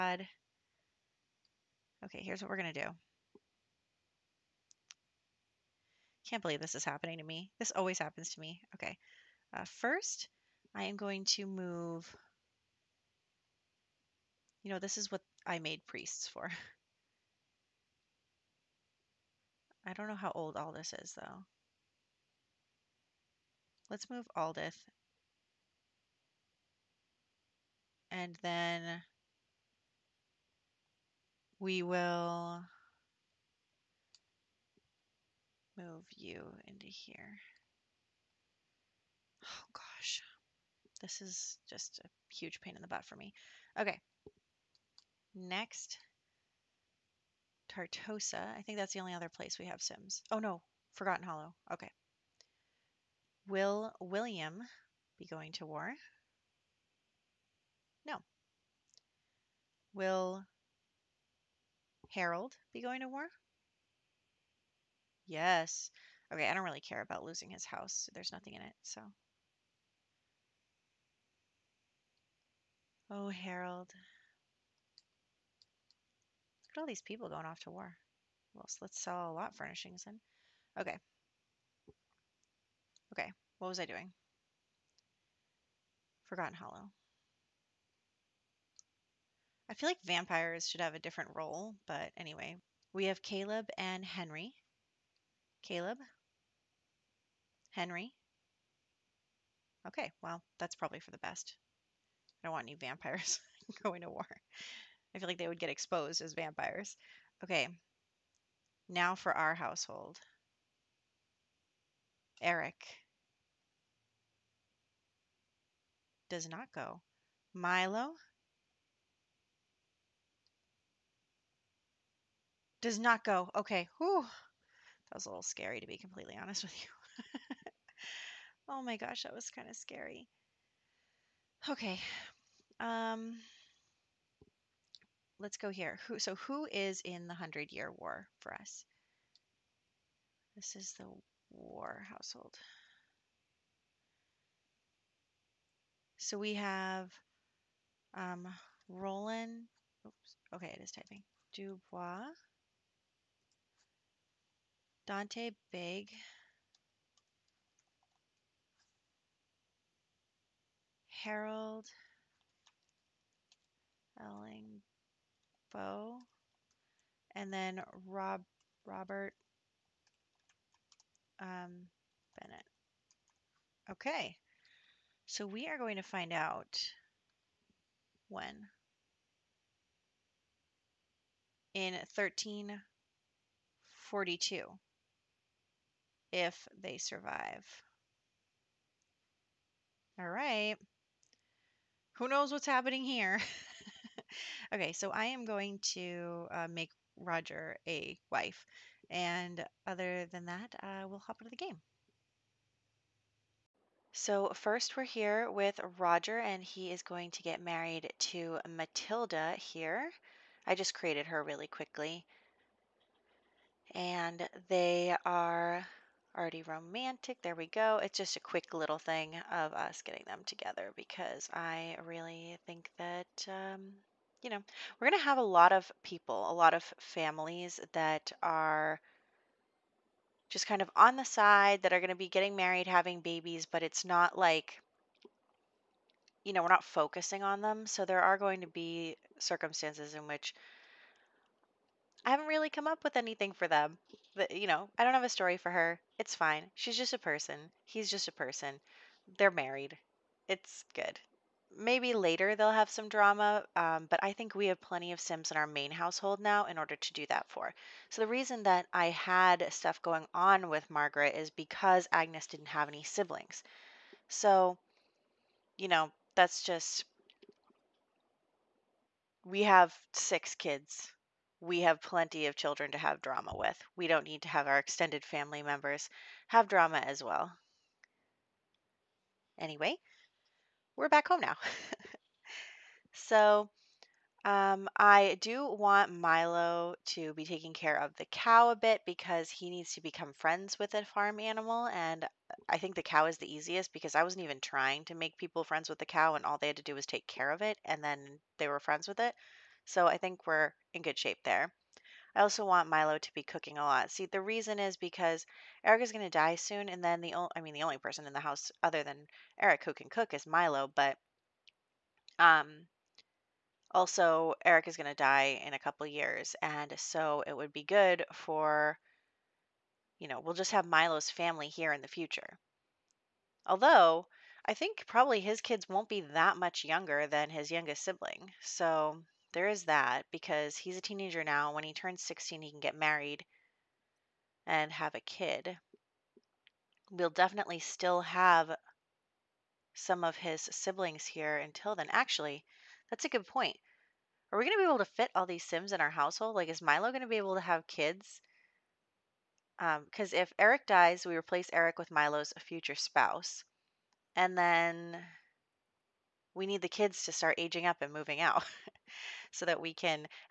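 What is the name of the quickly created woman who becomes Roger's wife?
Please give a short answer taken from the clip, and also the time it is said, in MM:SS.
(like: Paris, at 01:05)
Matilda, at 03:28.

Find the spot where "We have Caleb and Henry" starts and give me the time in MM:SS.
01:32.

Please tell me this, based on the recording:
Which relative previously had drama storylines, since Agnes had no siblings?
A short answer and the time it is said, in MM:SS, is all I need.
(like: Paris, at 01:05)
Margaret, at 04:20.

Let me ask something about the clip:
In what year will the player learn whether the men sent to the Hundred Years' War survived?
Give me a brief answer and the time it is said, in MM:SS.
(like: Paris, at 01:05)
1342, at 03:02.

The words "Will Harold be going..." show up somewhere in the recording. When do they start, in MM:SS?
00:59.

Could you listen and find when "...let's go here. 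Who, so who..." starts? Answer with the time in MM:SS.
02:15.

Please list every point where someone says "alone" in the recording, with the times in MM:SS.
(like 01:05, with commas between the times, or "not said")
not said.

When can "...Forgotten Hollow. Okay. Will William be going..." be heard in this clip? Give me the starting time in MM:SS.
00:50.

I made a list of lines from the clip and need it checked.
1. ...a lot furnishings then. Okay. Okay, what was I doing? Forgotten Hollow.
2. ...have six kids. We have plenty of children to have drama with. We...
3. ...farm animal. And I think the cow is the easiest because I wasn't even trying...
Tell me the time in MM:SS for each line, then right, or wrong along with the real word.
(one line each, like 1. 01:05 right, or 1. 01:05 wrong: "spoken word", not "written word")
1. 01:19 right
2. 04:29 right
3. 04:51 right.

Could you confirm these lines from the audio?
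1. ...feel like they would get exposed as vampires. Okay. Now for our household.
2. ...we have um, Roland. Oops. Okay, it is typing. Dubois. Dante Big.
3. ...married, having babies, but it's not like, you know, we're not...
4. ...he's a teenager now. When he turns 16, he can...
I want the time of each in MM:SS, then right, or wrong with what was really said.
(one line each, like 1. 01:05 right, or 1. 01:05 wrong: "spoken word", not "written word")
1. 01:45 right
2. 02:26 right
3. 03:52 right
4. 05:30 right.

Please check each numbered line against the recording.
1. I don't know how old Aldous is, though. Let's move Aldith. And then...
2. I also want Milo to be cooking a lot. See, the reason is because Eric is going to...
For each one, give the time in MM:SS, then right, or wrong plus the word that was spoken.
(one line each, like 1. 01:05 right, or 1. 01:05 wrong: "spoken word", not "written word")
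1. 00:19 right
2. 05:02 right.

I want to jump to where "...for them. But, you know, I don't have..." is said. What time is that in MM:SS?
04:03.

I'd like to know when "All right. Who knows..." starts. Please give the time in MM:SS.
03:10.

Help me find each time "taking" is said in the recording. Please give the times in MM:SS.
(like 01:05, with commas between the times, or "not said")
04:47.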